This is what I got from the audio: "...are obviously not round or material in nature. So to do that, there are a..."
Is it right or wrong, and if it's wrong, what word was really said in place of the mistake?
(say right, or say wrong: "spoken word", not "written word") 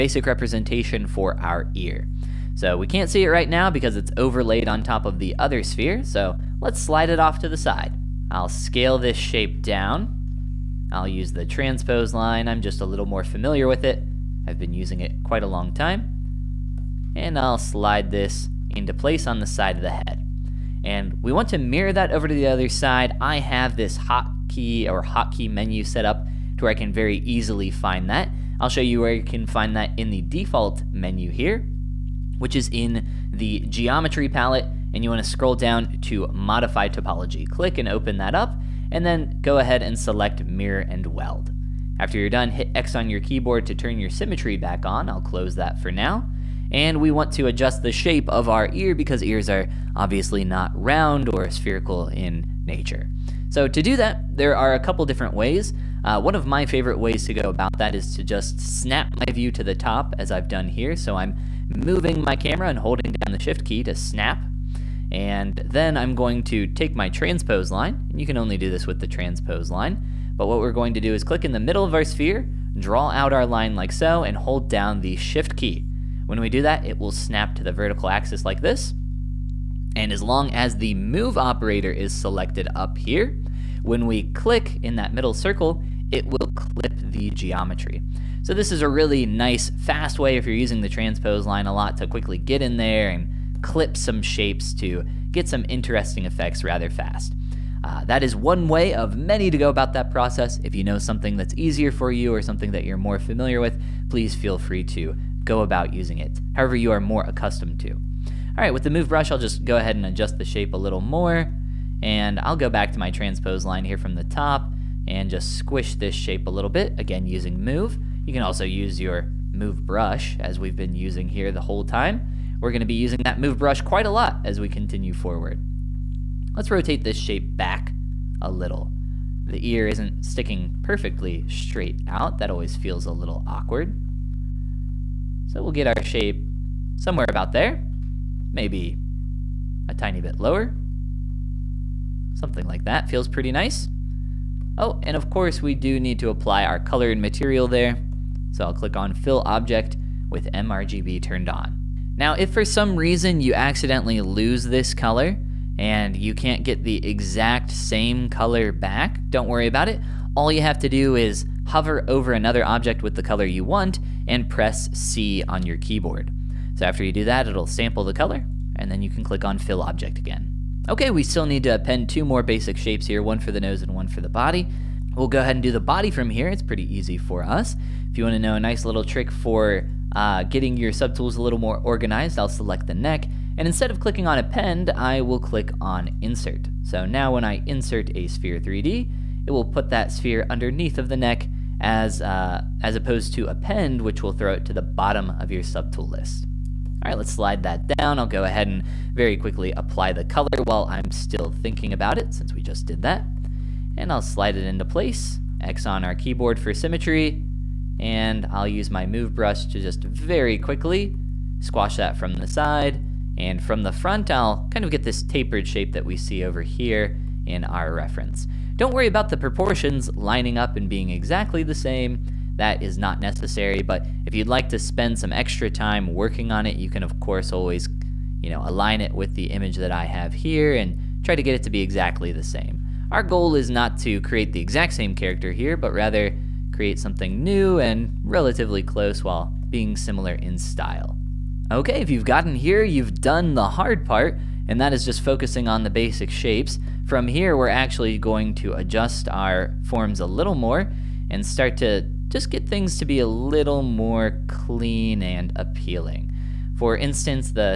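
wrong: "spherical", not "material".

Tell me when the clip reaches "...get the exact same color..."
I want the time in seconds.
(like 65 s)
156 s.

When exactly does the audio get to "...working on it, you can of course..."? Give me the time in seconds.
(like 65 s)
226 s.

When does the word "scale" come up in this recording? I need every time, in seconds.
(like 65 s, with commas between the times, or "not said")
8 s.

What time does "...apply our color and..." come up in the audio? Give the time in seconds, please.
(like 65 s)
146 s.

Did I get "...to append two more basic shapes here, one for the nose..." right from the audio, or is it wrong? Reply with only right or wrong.
right.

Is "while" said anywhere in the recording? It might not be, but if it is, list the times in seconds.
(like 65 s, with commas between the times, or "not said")
200 s, 239 s.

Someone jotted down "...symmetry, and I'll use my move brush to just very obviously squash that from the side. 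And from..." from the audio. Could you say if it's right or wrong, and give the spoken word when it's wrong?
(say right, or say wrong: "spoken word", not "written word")
wrong: "quickly", not "obviously".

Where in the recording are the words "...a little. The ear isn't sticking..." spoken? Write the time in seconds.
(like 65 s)
128 s.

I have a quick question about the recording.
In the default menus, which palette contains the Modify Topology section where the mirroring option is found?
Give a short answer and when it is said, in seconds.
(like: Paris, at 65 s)
Geometry palette, at 33 s.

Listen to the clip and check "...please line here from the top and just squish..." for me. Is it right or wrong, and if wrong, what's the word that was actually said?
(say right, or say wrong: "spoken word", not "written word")
wrong: "transpose", not "please".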